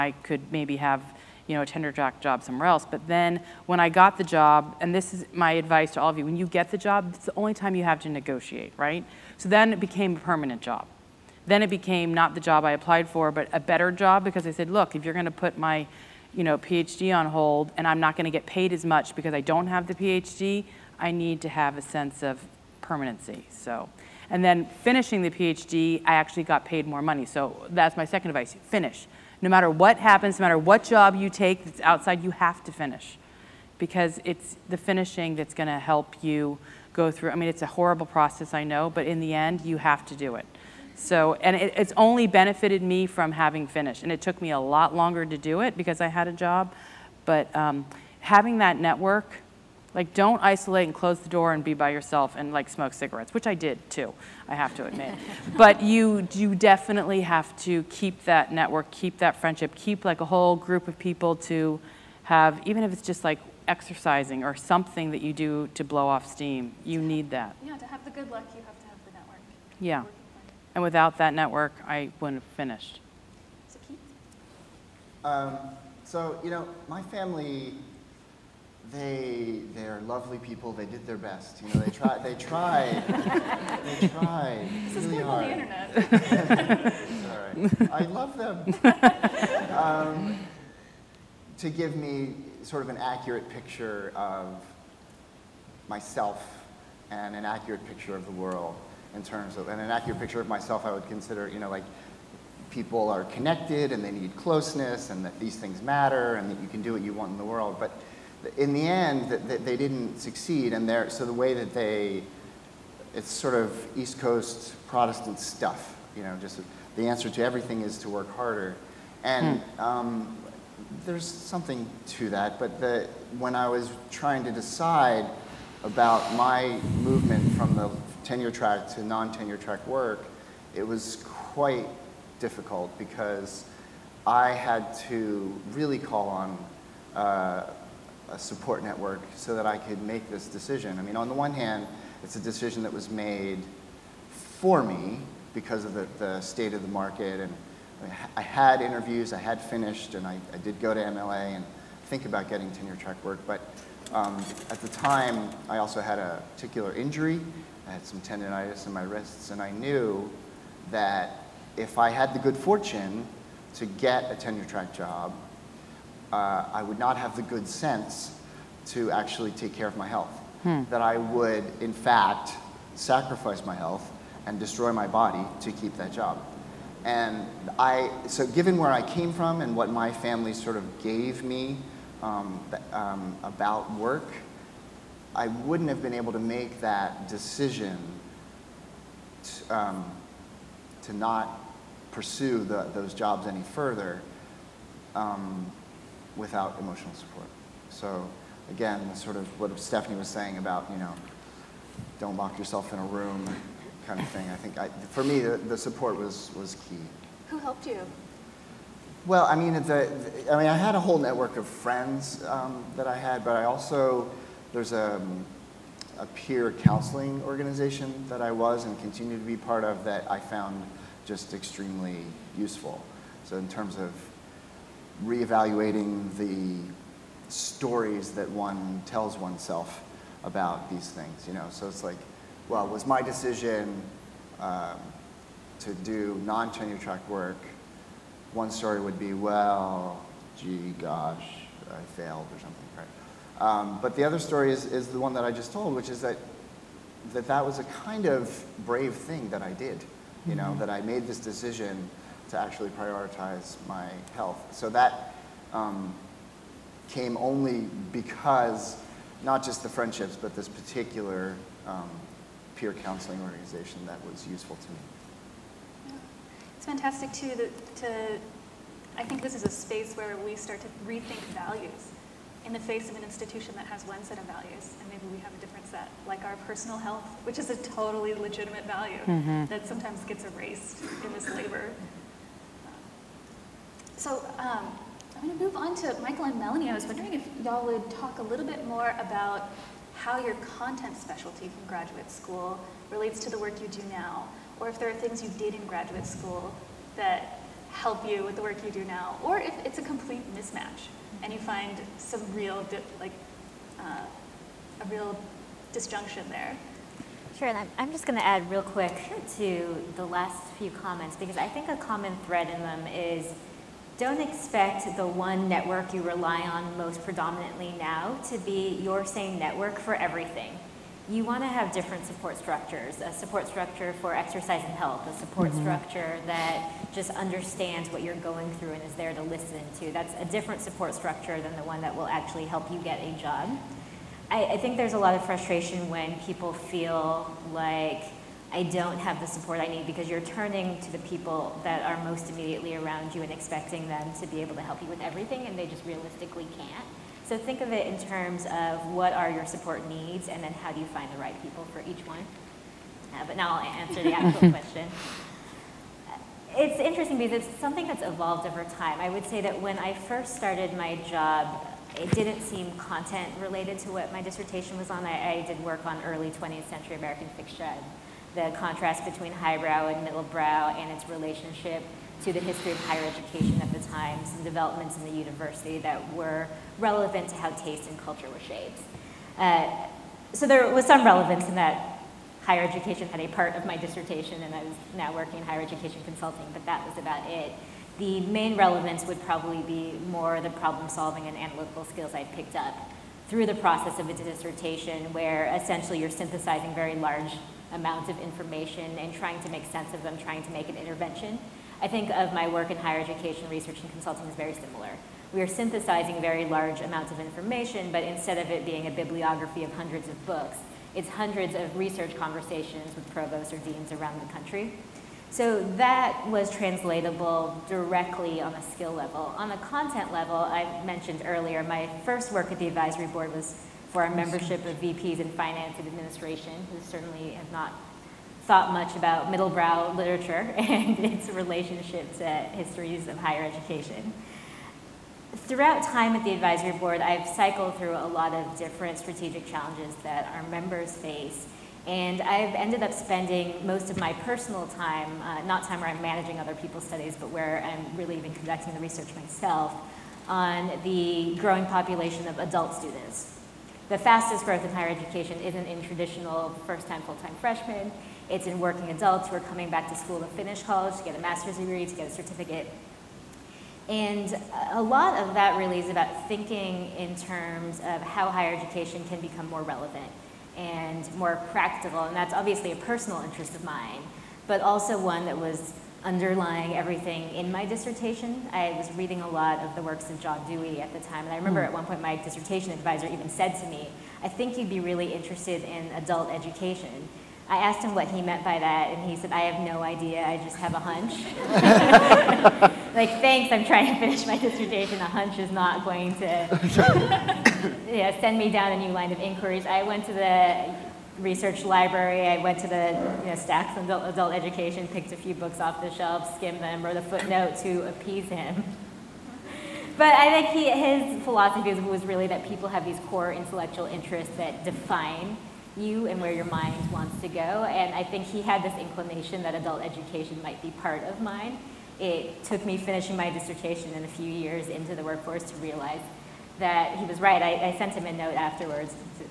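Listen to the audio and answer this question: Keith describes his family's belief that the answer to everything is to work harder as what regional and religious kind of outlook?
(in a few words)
East Coast Protestant.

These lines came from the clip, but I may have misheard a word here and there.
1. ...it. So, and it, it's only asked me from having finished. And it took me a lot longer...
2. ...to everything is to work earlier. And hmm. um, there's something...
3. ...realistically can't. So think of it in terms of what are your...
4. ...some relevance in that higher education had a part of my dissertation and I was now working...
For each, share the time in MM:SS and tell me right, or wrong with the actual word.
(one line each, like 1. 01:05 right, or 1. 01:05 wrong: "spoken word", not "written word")
1. 00:40 wrong: "benefited", not "asked"
2. 01:57 wrong: "harder", not "earlier"
3. 05:46 right
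4. 06:21 right.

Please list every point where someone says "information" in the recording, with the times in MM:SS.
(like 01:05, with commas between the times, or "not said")
06:38, 06:47.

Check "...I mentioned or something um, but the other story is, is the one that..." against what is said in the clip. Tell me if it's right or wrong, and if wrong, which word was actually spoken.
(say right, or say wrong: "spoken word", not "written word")
wrong: "failed", not "mentioned".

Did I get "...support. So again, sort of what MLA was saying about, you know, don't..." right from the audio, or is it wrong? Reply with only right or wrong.
wrong.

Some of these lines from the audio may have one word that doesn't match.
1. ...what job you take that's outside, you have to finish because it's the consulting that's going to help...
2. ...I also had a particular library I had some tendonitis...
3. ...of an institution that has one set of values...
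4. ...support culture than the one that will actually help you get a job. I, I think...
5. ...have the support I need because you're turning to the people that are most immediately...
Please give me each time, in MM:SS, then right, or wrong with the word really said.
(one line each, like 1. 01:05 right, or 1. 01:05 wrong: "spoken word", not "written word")
1. 00:30 wrong: "finishing", not "consulting"
2. 02:35 wrong: "injury", not "library"
3. 04:33 right
4. 05:30 wrong: "structure", not "culture"
5. 05:39 right.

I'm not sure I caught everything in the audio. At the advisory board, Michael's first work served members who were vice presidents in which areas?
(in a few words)
finance and administration.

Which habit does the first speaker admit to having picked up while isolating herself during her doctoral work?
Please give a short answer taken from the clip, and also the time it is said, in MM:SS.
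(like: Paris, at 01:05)
smoke cigarettes, at 00:52.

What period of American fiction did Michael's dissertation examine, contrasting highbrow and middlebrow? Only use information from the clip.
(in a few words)
early 20th century.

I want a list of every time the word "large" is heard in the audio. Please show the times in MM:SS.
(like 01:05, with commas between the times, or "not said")
06:37, 06:46.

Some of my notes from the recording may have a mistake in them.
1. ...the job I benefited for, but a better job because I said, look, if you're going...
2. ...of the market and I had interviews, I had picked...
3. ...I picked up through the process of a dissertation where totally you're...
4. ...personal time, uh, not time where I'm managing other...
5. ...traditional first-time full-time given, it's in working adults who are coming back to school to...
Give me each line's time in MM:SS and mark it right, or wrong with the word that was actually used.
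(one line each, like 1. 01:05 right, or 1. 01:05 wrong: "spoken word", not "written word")
1. 00:12 wrong: "applied", not "benefited"
2. 02:26 wrong: "finished", not "picked"
3. 06:32 wrong: "essentially", not "totally"
4. 07:24 right
5. 07:36 wrong: "freshmen", not "given".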